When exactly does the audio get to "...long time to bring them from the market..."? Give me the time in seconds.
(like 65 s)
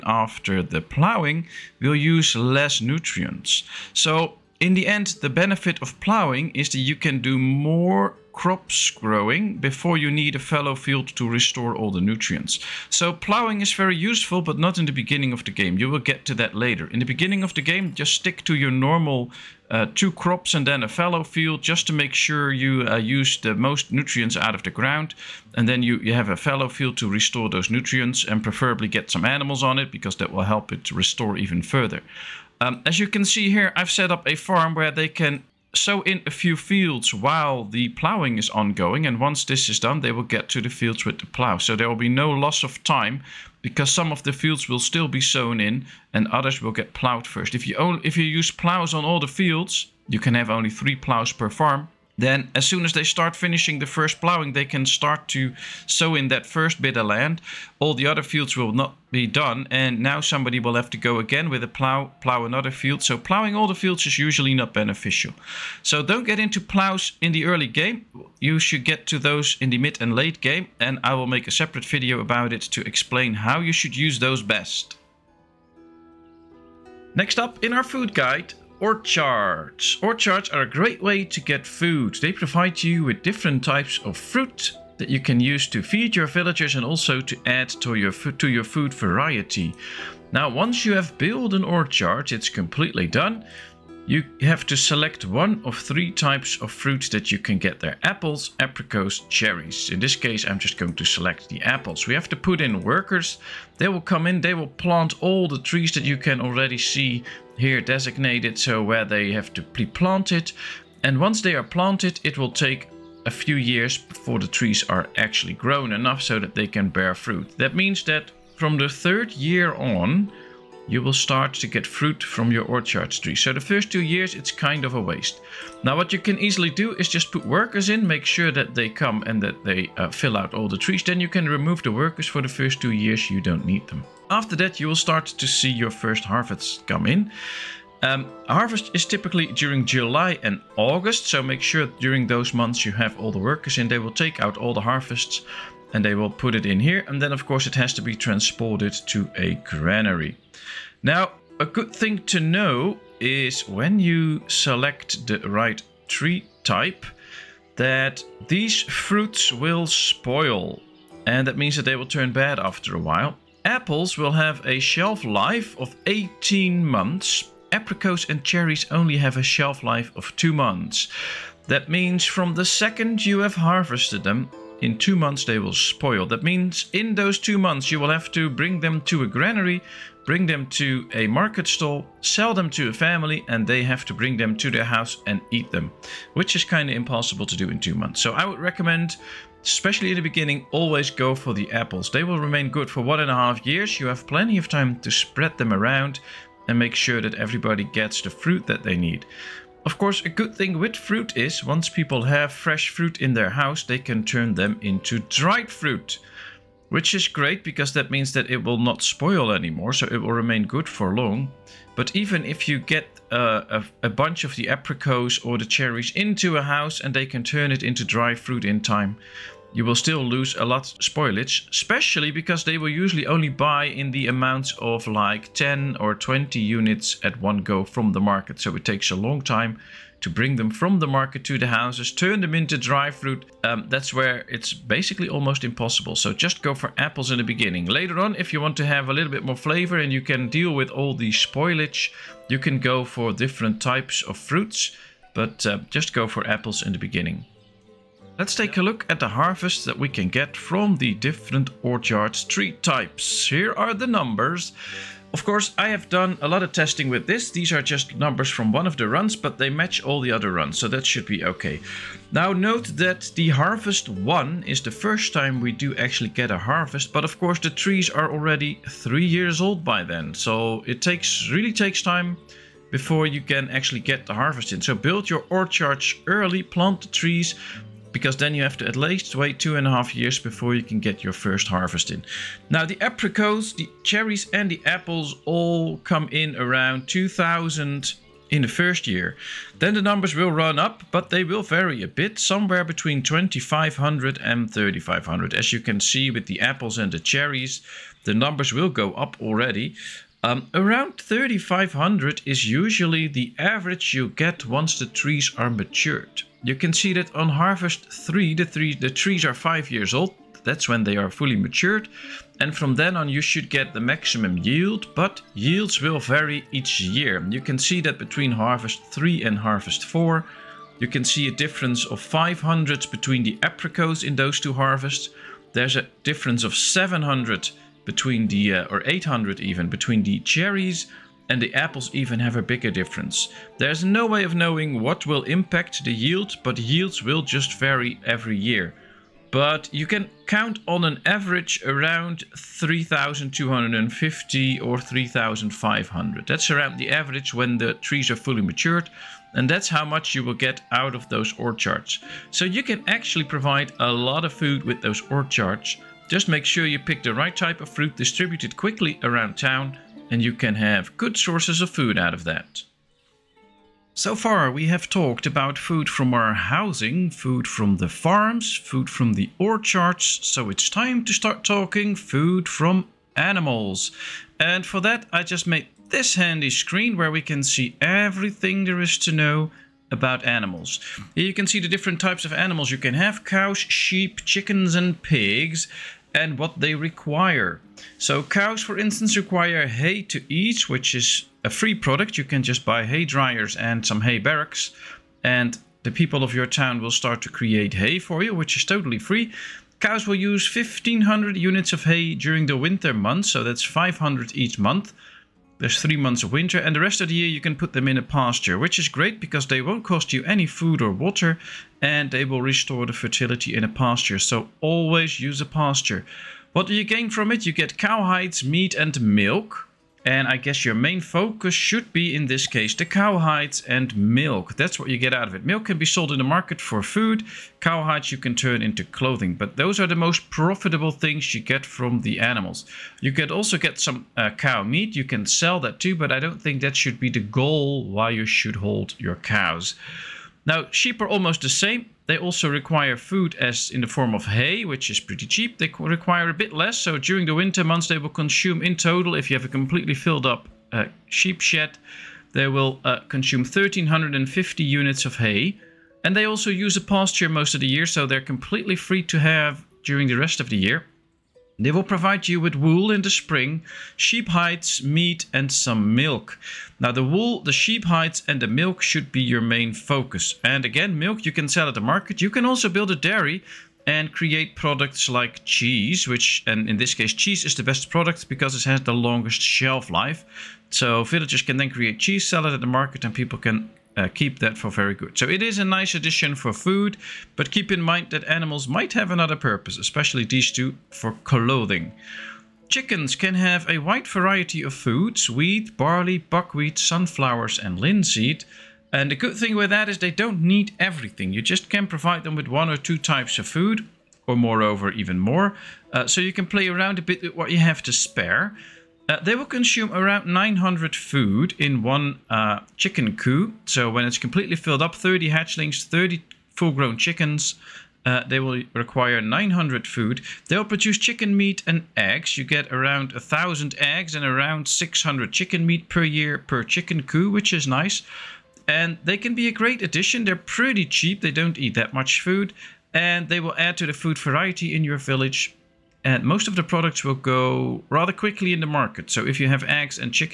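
229 s.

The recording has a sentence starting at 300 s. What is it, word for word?
Um, around 3500 is usually the average you get once the trees are matured.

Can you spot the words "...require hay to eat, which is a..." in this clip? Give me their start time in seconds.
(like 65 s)
389 s.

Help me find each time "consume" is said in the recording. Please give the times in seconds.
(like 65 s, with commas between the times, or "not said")
448 s, 453 s, 509 s.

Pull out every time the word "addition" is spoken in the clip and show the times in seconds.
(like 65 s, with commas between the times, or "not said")
486 s, 530 s.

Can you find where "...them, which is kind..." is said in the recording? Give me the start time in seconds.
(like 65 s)
185 s.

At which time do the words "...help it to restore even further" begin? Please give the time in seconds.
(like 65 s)
30 s.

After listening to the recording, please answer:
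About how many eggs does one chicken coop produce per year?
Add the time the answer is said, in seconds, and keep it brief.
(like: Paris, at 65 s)
1,000, at 522 s.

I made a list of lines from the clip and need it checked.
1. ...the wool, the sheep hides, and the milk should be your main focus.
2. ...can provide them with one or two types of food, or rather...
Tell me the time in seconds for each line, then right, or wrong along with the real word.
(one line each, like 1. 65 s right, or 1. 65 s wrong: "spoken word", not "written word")
1. 467 s right
2. 501 s wrong: "moreover", not "rather".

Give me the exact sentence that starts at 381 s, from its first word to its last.
Here you can see the different types of animals you can have.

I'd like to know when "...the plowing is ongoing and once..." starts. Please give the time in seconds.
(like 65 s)
37 s.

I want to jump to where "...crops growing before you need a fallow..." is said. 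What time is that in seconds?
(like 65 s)
8 s.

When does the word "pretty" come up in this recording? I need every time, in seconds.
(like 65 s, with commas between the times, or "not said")
445 s, 530 s.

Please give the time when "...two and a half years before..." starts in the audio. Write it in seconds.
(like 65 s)
279 s.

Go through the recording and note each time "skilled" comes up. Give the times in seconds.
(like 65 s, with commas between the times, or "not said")
not said.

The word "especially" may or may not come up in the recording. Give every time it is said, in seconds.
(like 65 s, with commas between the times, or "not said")
189 s, 221 s, 489 s.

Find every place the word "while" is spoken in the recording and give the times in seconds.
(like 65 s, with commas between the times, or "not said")
37 s, 163 s.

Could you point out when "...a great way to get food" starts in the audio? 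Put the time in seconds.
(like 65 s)
80 s.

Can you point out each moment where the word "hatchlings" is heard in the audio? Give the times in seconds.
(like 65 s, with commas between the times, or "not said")
515 s.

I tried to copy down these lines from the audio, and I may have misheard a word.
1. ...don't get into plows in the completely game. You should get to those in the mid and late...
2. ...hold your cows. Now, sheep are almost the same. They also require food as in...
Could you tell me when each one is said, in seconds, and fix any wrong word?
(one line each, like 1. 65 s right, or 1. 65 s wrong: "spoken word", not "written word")
1. 66 s wrong: "early", not "completely"
2. 438 s right.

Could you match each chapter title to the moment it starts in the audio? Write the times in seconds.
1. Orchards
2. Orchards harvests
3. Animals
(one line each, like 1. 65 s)
1. 75 s
2. 248 s
3. 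363 s.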